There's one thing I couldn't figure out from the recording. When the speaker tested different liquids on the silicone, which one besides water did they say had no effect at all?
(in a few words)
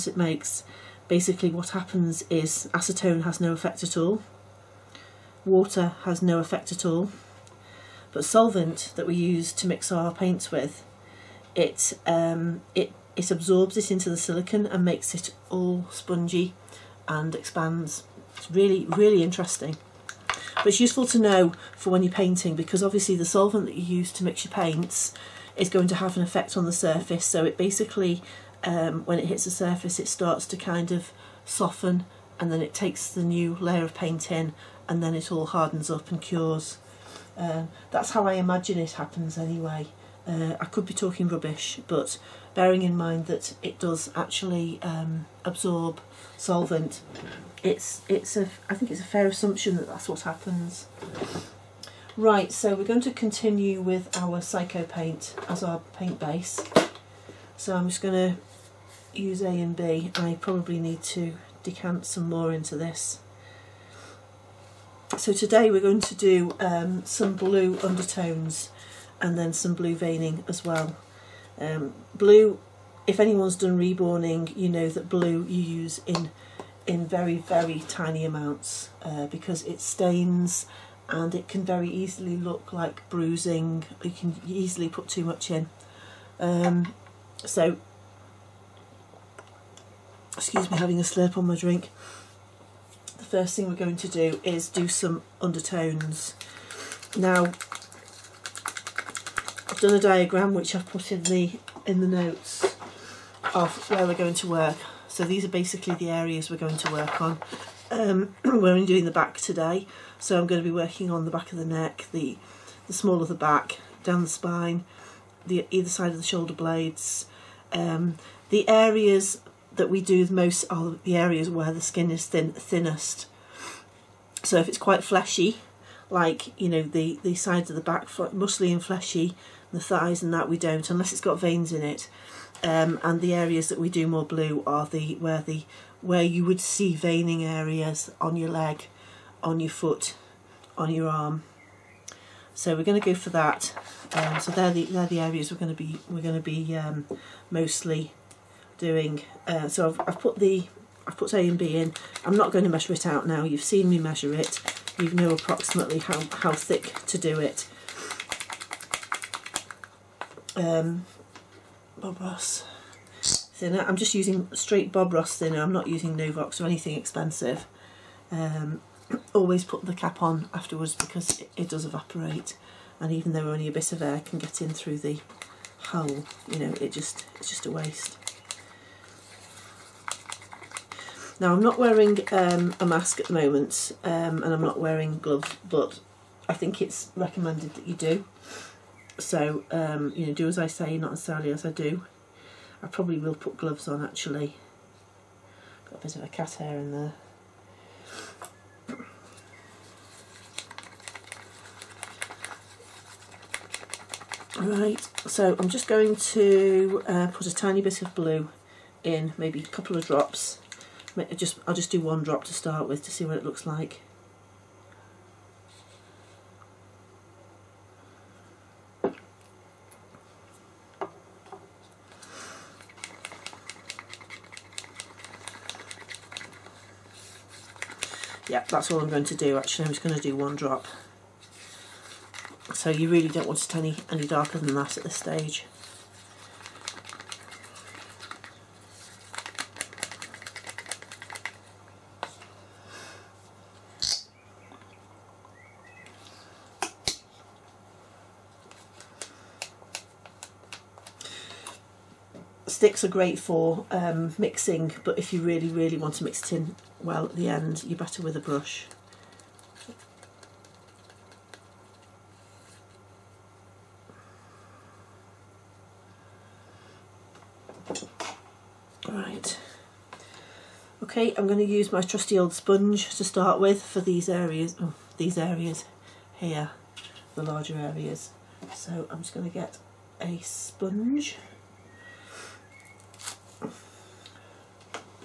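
Acetone.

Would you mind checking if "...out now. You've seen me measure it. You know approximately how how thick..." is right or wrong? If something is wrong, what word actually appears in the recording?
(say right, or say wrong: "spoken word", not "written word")
right.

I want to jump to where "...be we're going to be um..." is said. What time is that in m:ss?
2:25.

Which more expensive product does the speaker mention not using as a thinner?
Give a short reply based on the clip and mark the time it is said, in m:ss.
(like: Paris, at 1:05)
Novox, at 2:46.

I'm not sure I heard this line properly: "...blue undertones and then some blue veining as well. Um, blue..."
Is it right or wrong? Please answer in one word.
right.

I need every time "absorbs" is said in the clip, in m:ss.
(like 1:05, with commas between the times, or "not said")
0:13, 0:45.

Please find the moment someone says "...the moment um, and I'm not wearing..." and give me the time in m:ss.
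3:03.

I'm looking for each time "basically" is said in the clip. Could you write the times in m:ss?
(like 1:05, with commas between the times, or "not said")
0:01, 0:27, 1:45.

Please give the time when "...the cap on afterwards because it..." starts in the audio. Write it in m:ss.
2:49.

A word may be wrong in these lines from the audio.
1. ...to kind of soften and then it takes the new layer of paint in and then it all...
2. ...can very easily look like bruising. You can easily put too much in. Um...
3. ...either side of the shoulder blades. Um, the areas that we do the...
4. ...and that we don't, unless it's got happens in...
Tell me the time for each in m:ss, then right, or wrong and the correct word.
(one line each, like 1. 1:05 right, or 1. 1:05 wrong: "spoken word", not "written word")
1. 0:30 right
2. 1:21 right
3. 1:55 right
4. 2:10 wrong: "veins", not "happens".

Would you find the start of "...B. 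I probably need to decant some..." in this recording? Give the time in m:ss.
0:59.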